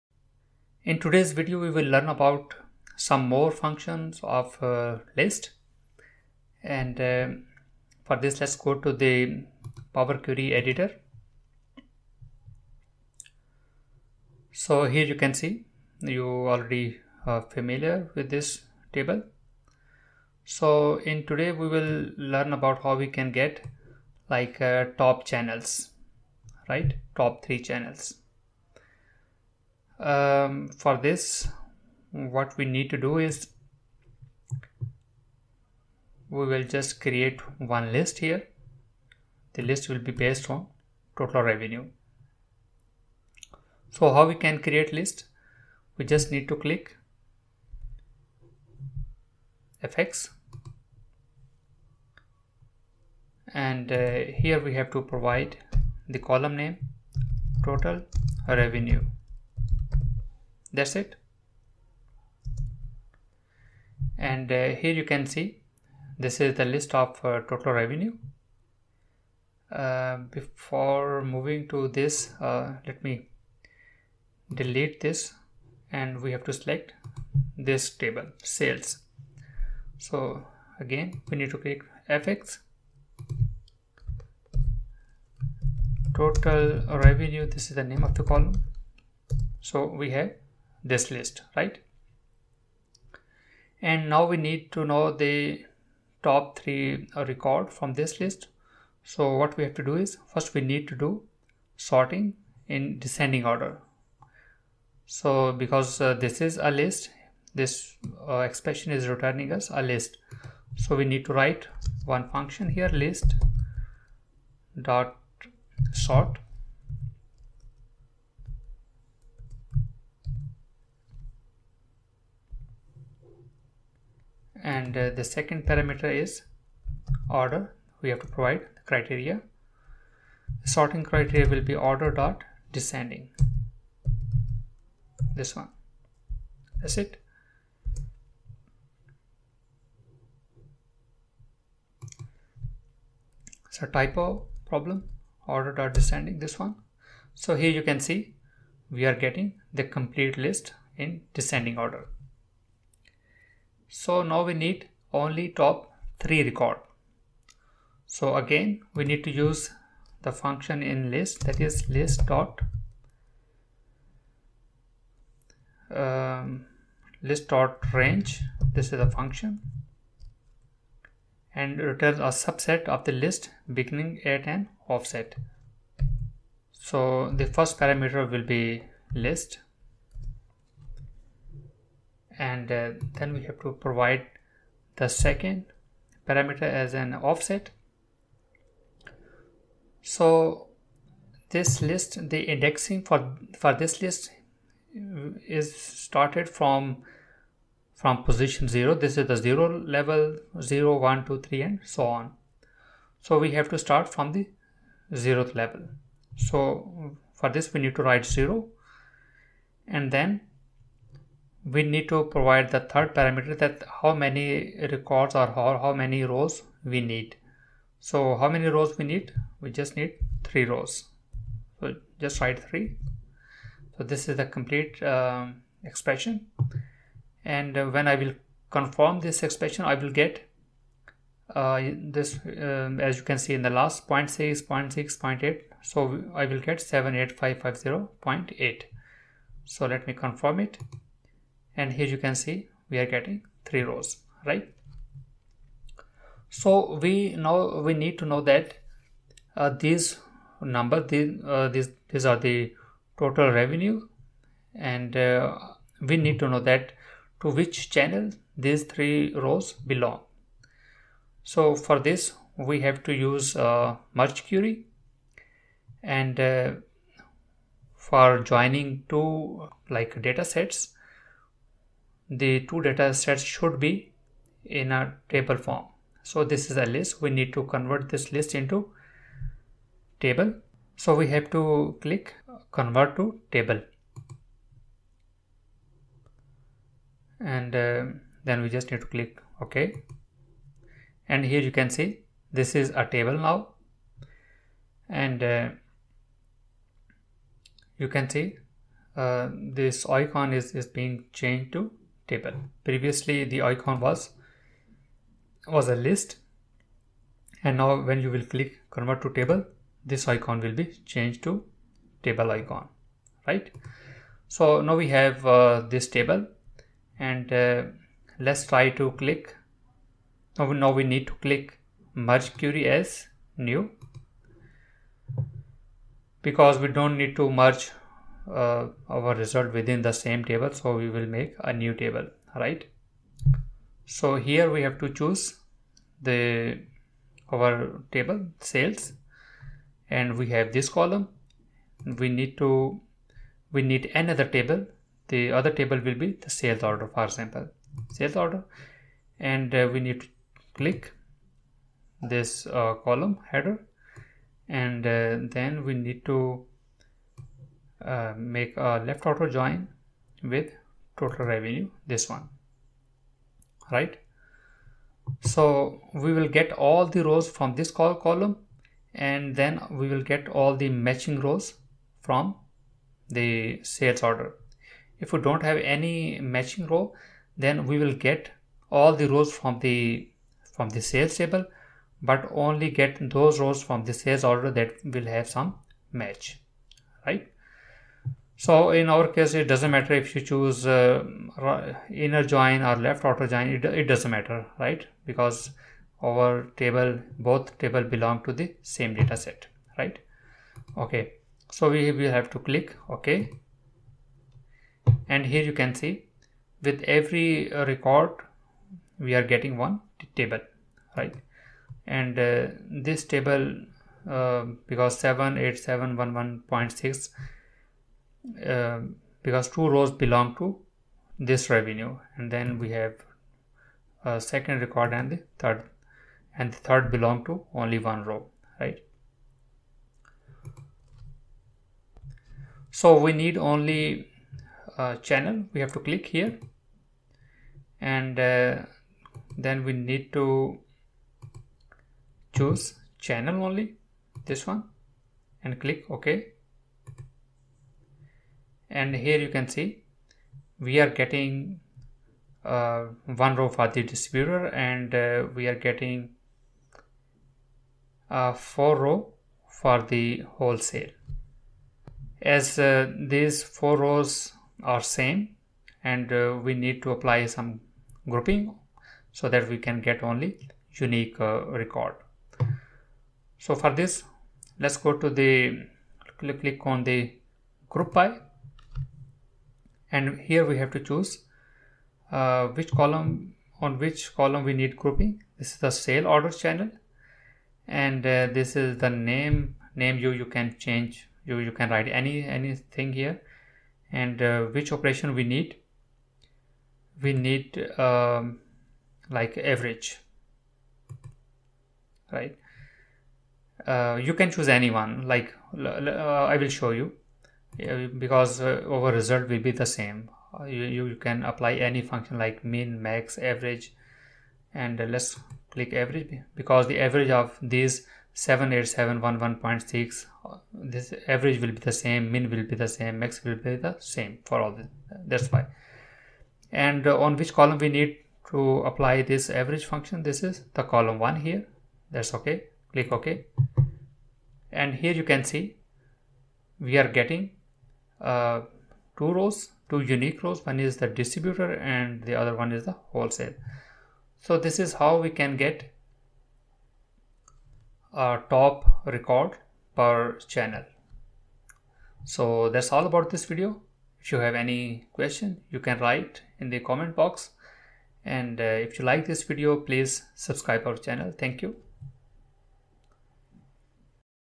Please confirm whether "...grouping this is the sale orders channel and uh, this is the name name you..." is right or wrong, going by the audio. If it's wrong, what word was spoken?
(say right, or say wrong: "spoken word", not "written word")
right.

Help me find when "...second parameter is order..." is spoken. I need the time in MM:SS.
02:05.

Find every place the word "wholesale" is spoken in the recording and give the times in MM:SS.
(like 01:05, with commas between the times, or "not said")
07:40, 09:03.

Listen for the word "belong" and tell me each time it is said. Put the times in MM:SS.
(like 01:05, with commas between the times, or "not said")
04:19, 06:38, 07:00, 07:07.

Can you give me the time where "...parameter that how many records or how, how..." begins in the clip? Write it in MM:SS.
03:33.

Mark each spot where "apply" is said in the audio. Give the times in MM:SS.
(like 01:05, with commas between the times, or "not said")
07:47, 08:31, 08:48.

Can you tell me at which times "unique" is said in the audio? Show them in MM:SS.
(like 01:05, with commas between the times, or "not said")
07:50, 09:00.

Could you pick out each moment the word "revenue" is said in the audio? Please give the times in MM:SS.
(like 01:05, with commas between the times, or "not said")
00:41, 00:58, 01:07, 01:27, 04:13, 06:01, 07:01.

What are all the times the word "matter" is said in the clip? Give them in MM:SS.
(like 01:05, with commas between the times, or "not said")
06:29, 06:34.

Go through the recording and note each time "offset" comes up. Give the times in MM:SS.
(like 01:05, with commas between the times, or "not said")
02:54, 03:07.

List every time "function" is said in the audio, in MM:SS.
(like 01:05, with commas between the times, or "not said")
00:03, 01:52, 02:40, 02:49, 08:32, 08:49.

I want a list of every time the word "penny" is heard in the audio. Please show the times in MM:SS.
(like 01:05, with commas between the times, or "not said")
not said.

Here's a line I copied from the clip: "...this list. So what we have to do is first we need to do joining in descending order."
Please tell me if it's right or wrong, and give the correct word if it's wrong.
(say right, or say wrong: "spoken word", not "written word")
wrong: "sorting", not "joining".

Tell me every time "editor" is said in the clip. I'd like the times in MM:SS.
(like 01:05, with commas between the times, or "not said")
00:10.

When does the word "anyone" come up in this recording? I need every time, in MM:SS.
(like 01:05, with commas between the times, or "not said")
08:24.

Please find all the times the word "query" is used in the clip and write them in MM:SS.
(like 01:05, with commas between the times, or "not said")
00:10, 04:24, 05:22.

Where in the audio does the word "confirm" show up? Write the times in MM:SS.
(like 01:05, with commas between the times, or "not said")
03:48, 04:00.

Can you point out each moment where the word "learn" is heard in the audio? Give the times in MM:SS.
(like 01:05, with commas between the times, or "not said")
00:01, 00:22.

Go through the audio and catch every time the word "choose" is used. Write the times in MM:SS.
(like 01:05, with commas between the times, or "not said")
05:35, 06:30, 07:22, 08:00, 08:24.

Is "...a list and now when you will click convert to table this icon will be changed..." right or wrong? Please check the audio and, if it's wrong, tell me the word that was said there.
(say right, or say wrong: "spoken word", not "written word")
right.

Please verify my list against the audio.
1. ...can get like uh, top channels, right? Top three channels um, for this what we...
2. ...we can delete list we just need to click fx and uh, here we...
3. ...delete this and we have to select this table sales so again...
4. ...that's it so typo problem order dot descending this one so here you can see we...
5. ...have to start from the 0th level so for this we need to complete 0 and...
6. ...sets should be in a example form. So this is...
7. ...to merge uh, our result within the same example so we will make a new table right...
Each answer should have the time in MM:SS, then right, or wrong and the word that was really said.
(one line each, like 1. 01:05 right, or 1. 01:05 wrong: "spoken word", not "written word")
1. 00:23 right
2. 00:44 wrong: "create", not "delete"
3. 01:14 right
4. 02:16 right
5. 03:23 wrong: "write", not "complete"
6. 04:33 wrong: "table", not "example"
7. 05:27 wrong: "table", not "example".